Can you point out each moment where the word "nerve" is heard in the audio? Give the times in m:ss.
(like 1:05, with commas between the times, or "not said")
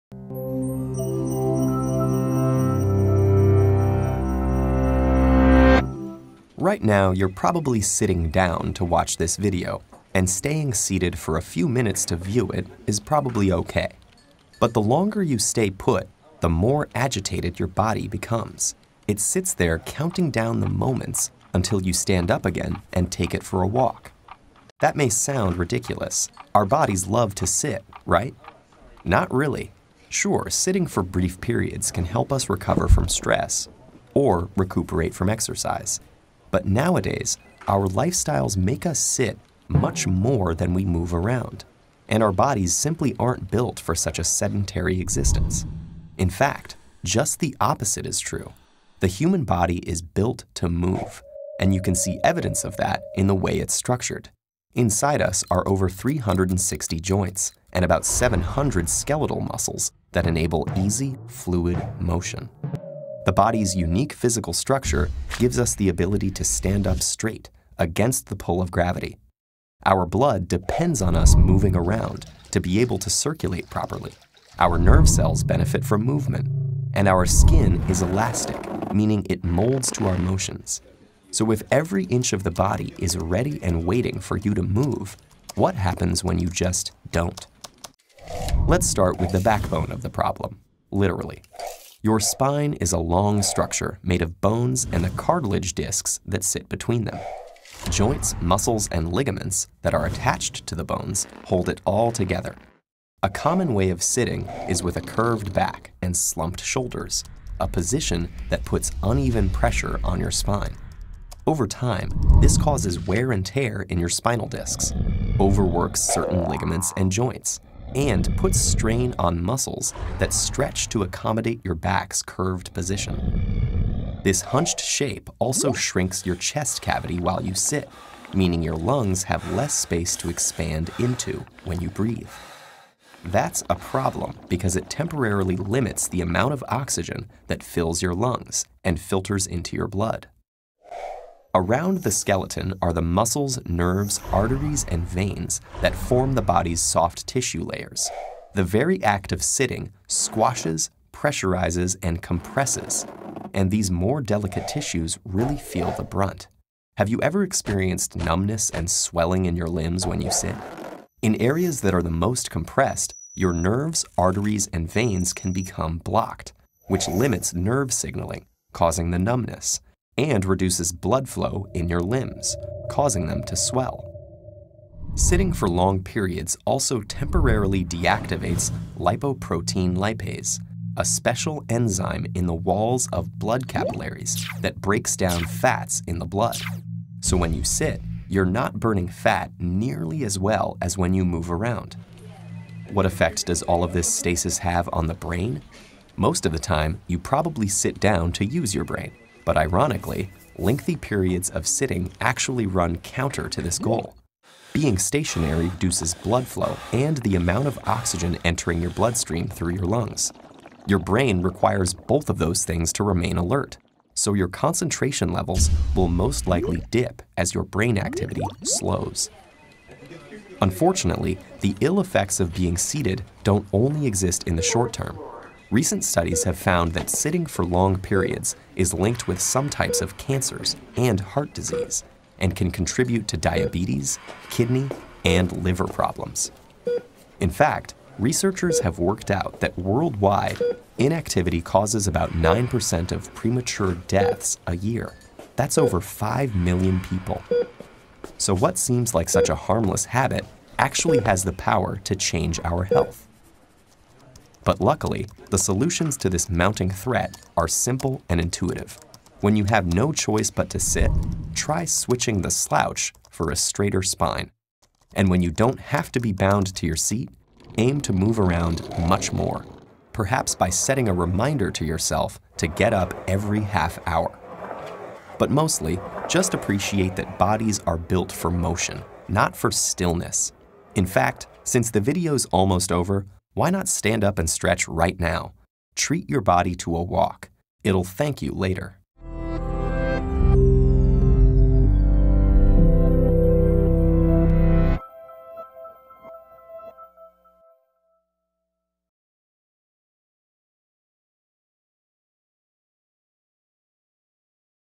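1:14, 2:23, 2:43, 2:47.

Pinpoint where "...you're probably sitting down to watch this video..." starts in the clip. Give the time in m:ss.
0:07.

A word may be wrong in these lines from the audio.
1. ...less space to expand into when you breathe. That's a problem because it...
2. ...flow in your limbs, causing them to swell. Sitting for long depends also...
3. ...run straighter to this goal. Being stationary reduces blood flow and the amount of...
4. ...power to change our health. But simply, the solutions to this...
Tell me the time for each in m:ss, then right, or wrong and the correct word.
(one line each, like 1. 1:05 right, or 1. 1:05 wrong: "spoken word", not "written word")
1. 2:09 right
2. 2:51 wrong: "periods", not "depends"
3. 3:22 wrong: "counter", not "straighter"
4. 4:11 wrong: "luckily", not "simply".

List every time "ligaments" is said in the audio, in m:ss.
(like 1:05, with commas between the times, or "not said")
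1:39, 1:56.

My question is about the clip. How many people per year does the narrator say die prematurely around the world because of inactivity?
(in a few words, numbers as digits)
over 5 million.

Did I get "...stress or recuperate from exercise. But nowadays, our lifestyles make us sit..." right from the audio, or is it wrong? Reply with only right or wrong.
right.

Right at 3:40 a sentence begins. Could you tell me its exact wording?
Unfortunately, the ill effects of being seated don't only exist in the short term.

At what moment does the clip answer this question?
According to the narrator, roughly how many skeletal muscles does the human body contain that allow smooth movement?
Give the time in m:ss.
0:57.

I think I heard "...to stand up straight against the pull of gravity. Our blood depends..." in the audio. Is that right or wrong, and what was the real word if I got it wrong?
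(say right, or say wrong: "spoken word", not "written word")
right.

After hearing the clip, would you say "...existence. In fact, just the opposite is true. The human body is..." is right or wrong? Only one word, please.
right.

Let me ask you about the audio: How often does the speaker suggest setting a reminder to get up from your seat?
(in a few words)
every half hour.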